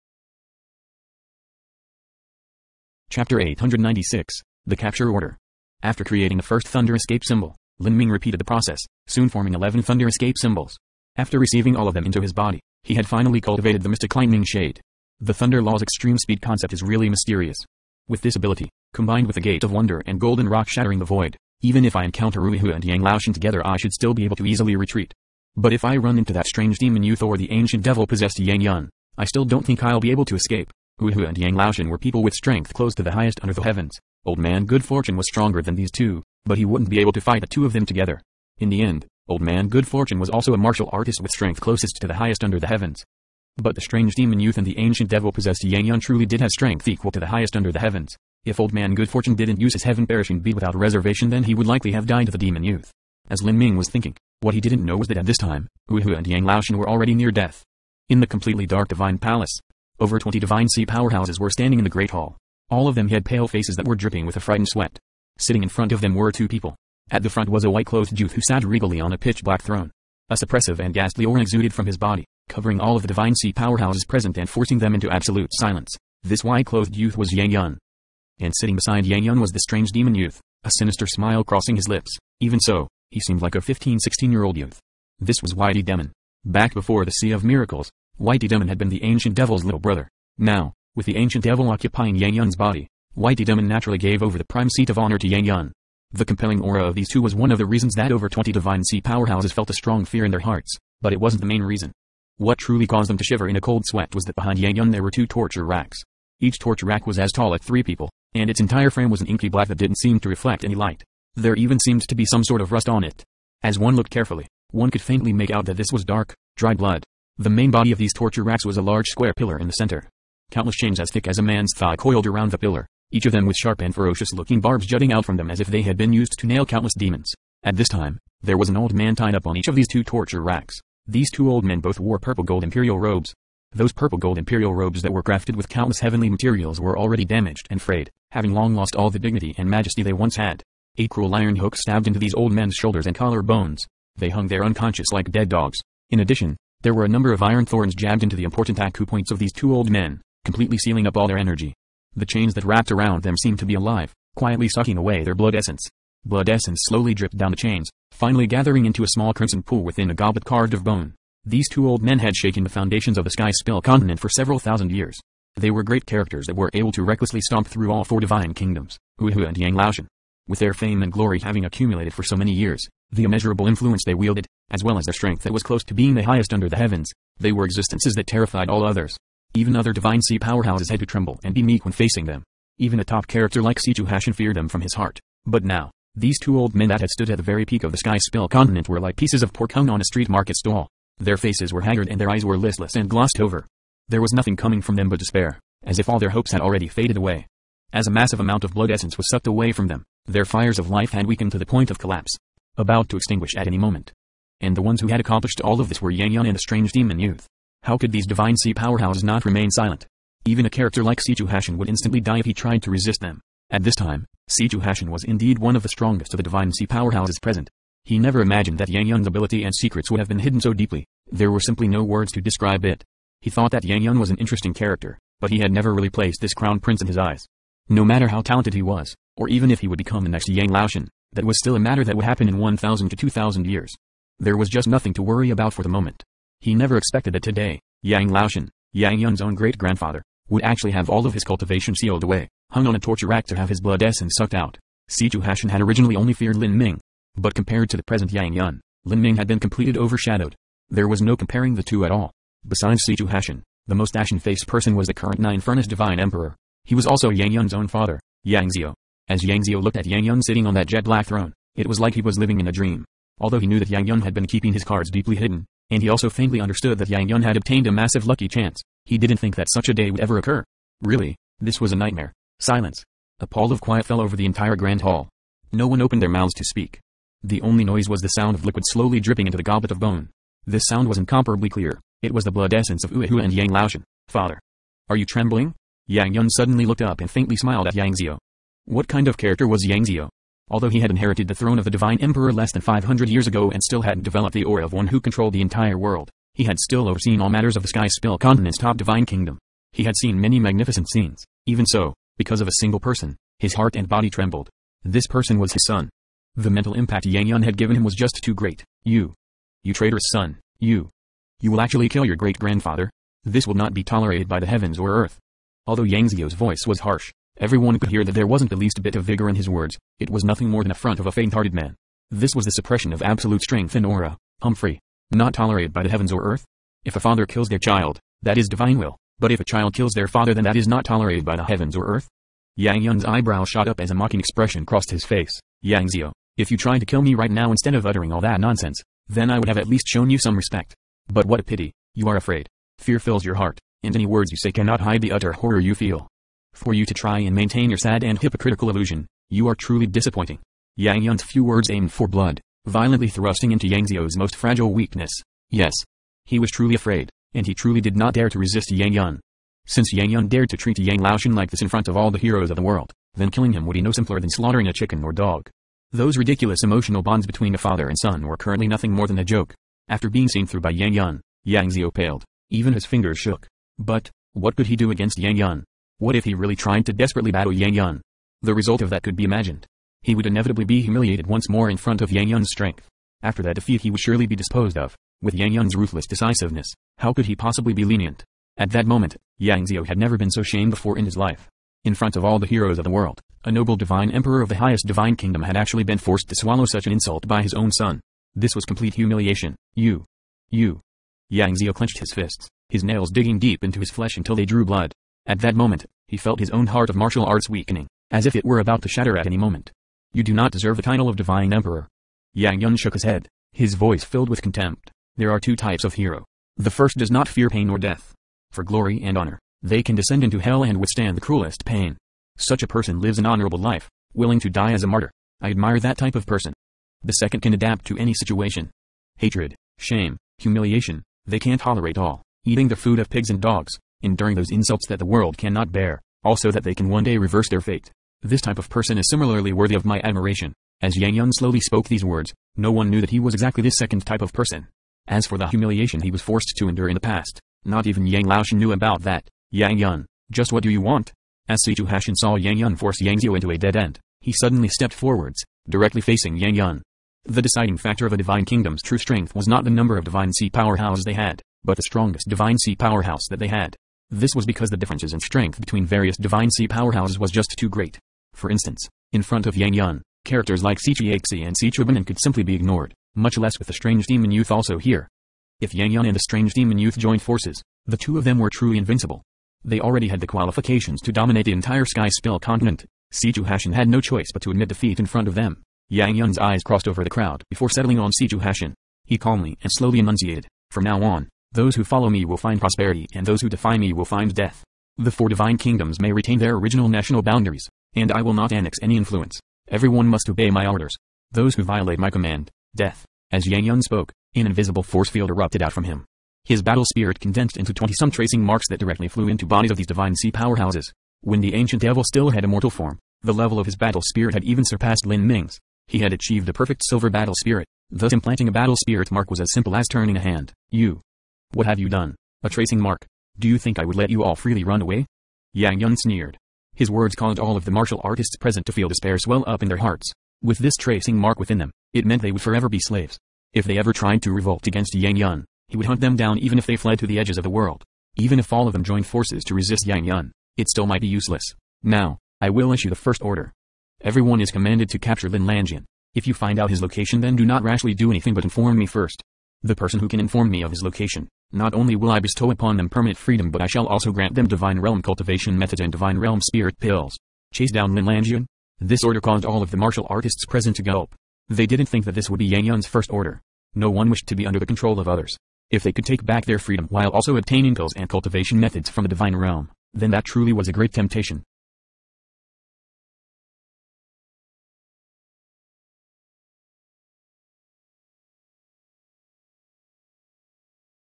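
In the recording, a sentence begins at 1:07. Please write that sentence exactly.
At the front was a white-clothed youth who sat regally on a pitch-black throne.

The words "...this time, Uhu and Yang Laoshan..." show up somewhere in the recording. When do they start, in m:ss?
0:55.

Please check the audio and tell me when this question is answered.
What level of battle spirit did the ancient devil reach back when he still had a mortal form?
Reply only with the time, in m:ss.
8:36.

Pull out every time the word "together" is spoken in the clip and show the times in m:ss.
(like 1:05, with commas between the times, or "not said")
0:23, 0:37.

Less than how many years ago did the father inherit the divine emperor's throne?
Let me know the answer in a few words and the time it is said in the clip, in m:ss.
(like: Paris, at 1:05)
500, at 4:52.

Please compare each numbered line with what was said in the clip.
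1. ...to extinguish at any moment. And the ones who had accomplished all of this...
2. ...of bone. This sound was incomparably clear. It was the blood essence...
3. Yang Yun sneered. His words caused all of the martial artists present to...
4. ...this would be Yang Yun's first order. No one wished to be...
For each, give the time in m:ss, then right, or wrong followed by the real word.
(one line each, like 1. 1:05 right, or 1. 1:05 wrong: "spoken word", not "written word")
1. 3:23 right
2. 4:39 right
3. 8:45 right
4. 9:22 right.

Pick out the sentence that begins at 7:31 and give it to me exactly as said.
As Situ Hashin saw Yang Yun force Yang Xiao into a dead end, he suddenly stepped forwards, directly facing Yang Yun.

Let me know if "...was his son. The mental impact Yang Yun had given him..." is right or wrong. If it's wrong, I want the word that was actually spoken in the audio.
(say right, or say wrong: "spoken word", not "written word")
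right.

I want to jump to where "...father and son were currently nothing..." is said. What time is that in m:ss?
6:07.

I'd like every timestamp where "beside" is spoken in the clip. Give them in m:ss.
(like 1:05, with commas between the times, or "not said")
1:18, 4:12.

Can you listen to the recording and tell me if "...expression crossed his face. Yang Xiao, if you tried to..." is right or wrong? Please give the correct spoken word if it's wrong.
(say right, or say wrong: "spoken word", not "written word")
right.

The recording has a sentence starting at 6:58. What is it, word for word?
For glory and honor, they can descend into hell and withstand the cruelest pain.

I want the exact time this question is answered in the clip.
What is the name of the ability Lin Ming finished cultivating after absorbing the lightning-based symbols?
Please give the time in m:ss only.
0:13.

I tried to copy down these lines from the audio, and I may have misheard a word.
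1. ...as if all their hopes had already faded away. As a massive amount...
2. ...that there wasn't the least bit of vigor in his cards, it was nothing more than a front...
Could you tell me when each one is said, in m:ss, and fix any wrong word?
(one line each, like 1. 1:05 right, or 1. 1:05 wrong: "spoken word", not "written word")
1. 3:15 right
2. 5:18 wrong: "words", not "cards".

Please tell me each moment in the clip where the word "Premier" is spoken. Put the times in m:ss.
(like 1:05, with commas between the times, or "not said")
not said.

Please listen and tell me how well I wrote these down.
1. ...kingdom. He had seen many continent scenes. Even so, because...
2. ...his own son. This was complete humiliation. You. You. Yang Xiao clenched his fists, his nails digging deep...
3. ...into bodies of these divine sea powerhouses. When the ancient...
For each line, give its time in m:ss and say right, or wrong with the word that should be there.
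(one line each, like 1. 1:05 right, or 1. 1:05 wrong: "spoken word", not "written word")
1. 4:59 wrong: "magnificent", not "continent"
2. 6:37 right
3. 8:29 right.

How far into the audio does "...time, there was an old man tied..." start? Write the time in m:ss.
2:07.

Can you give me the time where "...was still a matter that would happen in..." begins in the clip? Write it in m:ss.
3:51.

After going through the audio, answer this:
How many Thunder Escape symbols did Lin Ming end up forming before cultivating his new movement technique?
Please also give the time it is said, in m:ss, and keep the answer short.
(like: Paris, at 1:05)
11, at 0:09.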